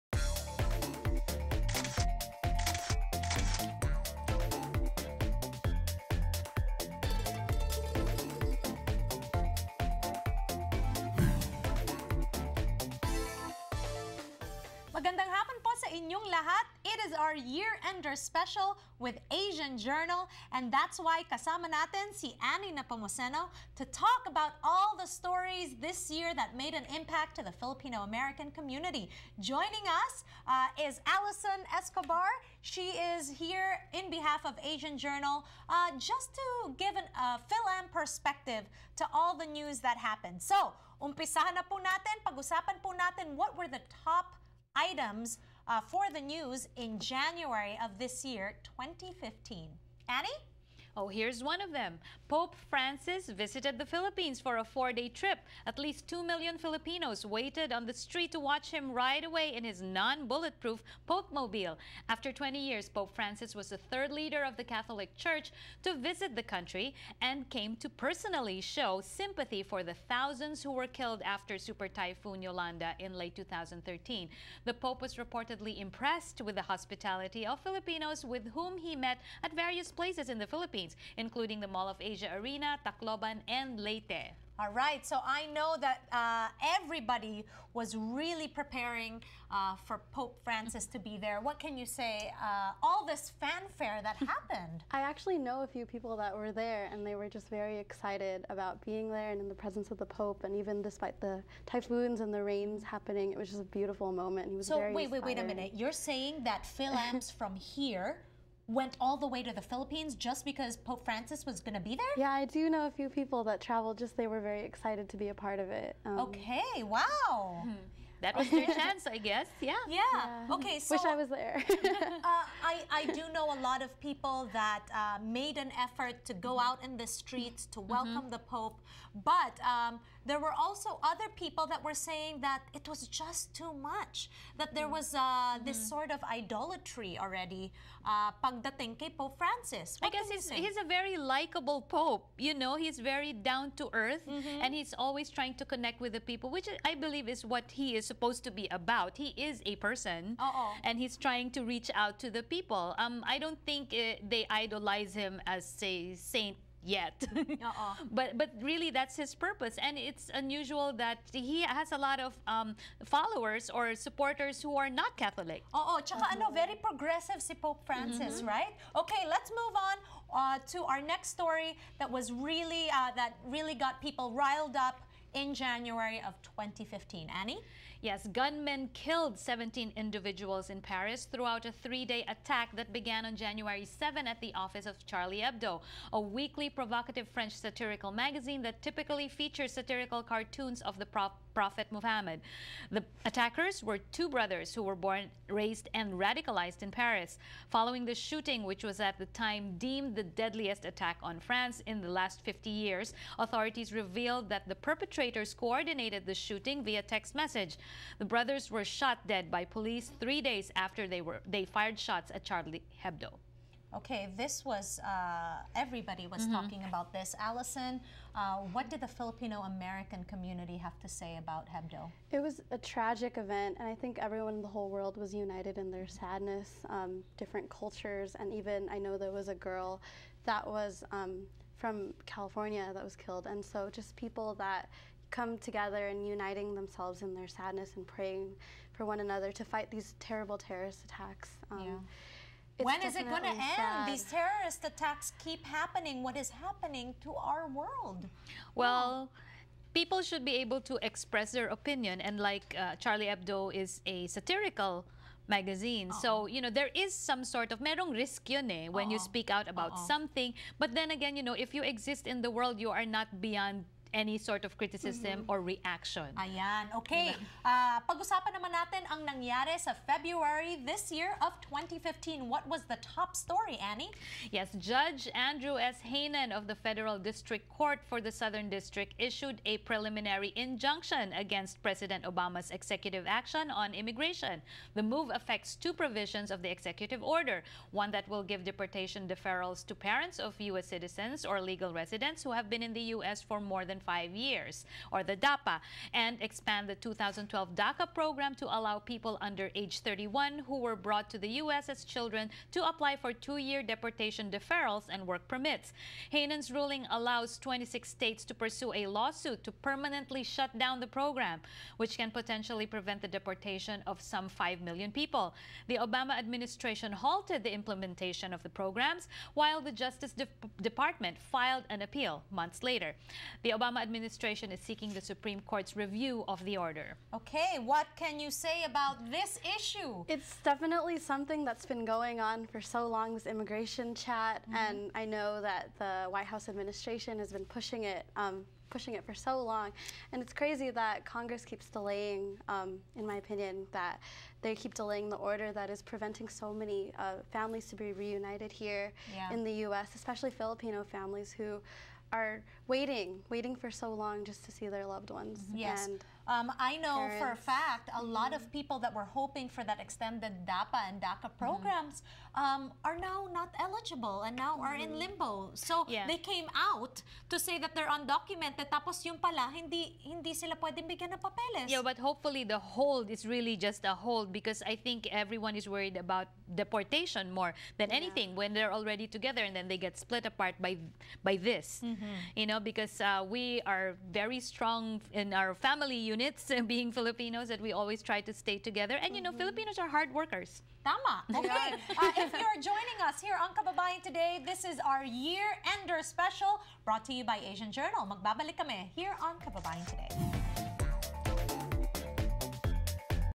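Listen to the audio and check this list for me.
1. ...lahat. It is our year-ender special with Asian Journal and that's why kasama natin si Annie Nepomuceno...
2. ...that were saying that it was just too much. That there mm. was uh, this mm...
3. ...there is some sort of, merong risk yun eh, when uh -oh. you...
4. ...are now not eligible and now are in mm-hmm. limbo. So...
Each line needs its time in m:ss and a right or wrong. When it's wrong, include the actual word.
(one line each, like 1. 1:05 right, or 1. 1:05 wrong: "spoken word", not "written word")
1. 0:16 right
2. 2:11 right
3. 4:16 right
4. 6:03 right.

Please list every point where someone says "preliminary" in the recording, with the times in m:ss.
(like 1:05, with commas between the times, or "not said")
4:39.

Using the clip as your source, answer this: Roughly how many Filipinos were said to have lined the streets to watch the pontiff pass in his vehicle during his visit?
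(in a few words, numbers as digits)
2 million.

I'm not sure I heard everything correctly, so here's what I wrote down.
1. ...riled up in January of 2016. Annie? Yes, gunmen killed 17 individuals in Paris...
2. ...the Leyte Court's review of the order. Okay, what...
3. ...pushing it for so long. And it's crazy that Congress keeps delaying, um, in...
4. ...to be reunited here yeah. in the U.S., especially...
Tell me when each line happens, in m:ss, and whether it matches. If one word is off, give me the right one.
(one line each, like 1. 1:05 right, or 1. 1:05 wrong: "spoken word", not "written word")
1. 2:54 wrong: "2015", not "2016"
2. 5:25 wrong: "Supreme", not "Leyte"
3. 5:38 right
4. 5:47 right.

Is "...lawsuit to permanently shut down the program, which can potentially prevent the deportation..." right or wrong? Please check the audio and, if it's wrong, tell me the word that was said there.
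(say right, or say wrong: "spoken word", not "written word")
right.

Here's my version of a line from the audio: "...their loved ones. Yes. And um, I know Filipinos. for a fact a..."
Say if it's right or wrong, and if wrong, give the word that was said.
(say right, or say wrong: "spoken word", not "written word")
wrong: "Parents", not "Filipinos".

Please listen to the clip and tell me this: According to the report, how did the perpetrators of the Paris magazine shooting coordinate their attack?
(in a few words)
text message.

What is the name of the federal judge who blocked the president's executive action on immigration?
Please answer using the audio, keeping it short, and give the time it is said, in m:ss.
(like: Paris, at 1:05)
Andrew S. Hanen, at 4:35.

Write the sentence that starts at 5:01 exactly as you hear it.
as children to apply for two-year deportation deferrals and work permits.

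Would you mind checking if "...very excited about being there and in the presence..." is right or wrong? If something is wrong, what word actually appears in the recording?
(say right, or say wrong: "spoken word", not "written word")
right.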